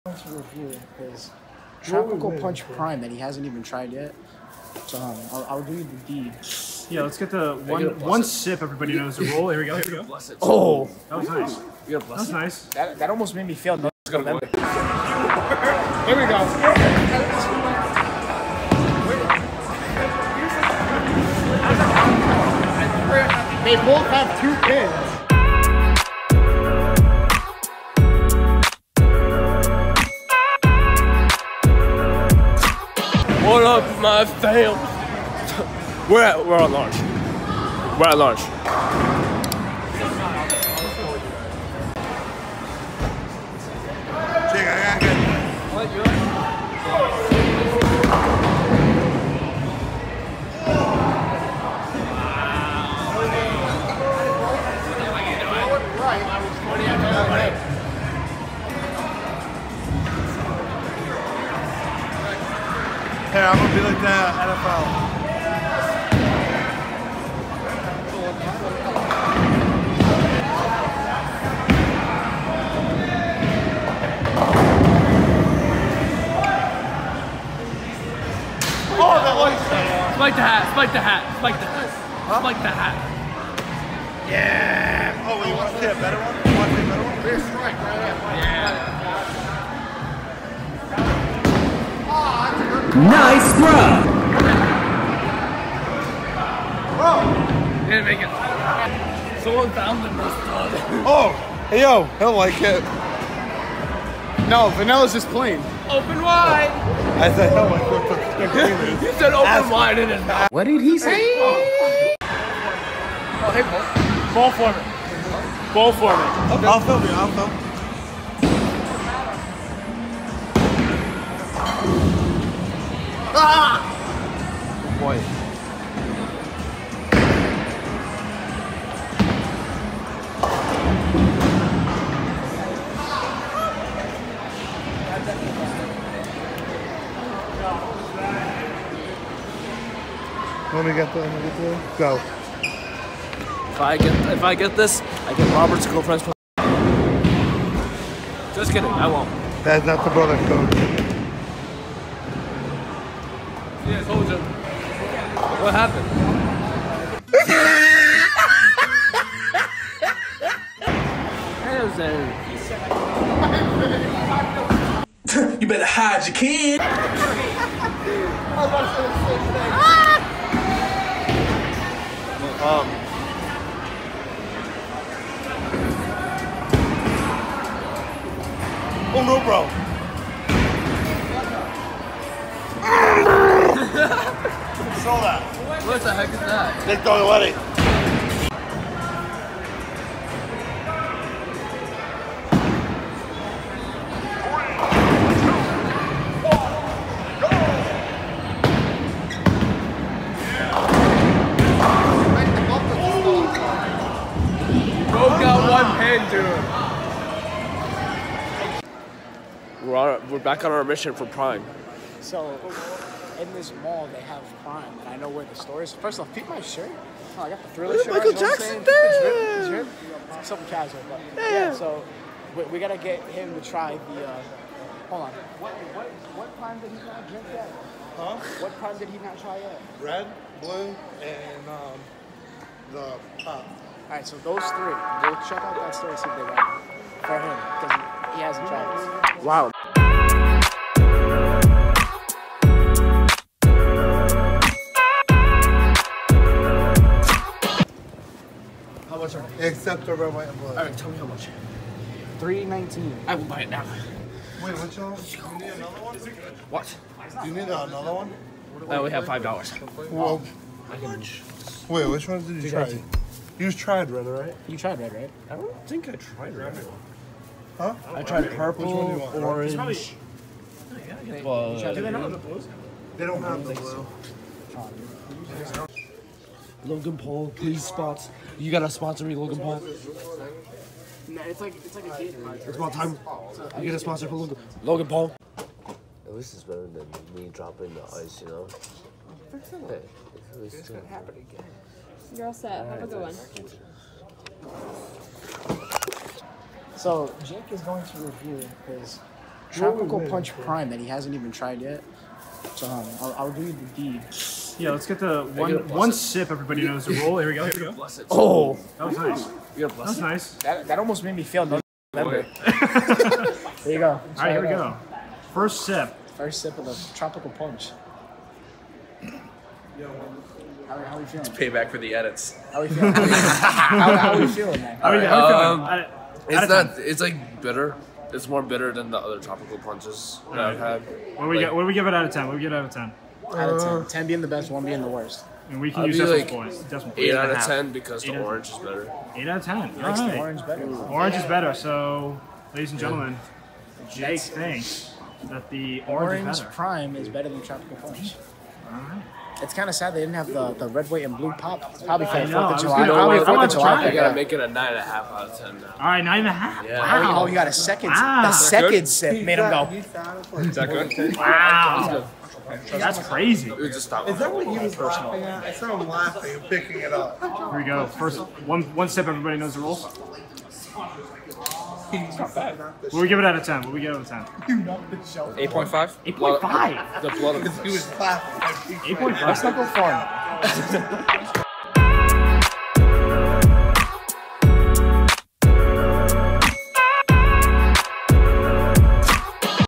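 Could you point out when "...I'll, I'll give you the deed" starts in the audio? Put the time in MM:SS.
00:05.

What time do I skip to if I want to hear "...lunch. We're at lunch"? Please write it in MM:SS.
00:36.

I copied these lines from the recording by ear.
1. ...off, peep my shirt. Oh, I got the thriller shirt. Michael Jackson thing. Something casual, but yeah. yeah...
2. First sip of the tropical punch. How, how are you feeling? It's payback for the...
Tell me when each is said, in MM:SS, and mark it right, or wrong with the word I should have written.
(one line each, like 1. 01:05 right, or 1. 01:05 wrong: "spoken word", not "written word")
1. 03:36 right
2. 05:16 right.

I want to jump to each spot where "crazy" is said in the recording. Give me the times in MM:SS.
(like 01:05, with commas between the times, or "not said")
06:03.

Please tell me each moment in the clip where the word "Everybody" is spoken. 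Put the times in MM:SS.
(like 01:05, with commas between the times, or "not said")
00:08, 05:06, 06:09.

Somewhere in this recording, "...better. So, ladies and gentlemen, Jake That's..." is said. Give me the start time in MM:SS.
05:41.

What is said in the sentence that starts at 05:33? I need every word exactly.
Uh, ten being the best, one being the worst.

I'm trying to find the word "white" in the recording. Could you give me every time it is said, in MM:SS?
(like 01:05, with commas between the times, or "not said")
04:10, 05:51.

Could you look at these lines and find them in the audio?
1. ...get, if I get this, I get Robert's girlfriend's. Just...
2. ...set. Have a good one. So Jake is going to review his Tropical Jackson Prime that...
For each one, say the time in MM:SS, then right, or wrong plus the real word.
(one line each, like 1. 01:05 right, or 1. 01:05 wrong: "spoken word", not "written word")
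1. 02:23 right
2. 04:52 wrong: "Punch", not "Jackson".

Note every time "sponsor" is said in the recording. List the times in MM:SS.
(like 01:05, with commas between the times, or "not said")
04:38, 04:43.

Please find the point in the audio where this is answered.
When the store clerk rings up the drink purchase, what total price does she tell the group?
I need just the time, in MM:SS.
04:12.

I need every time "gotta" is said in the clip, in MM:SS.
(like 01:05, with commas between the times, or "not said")
03:42, 04:38, 05:54.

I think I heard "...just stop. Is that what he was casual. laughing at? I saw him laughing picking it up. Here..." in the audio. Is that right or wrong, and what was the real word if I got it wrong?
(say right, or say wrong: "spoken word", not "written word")
wrong: "personal", not "casual".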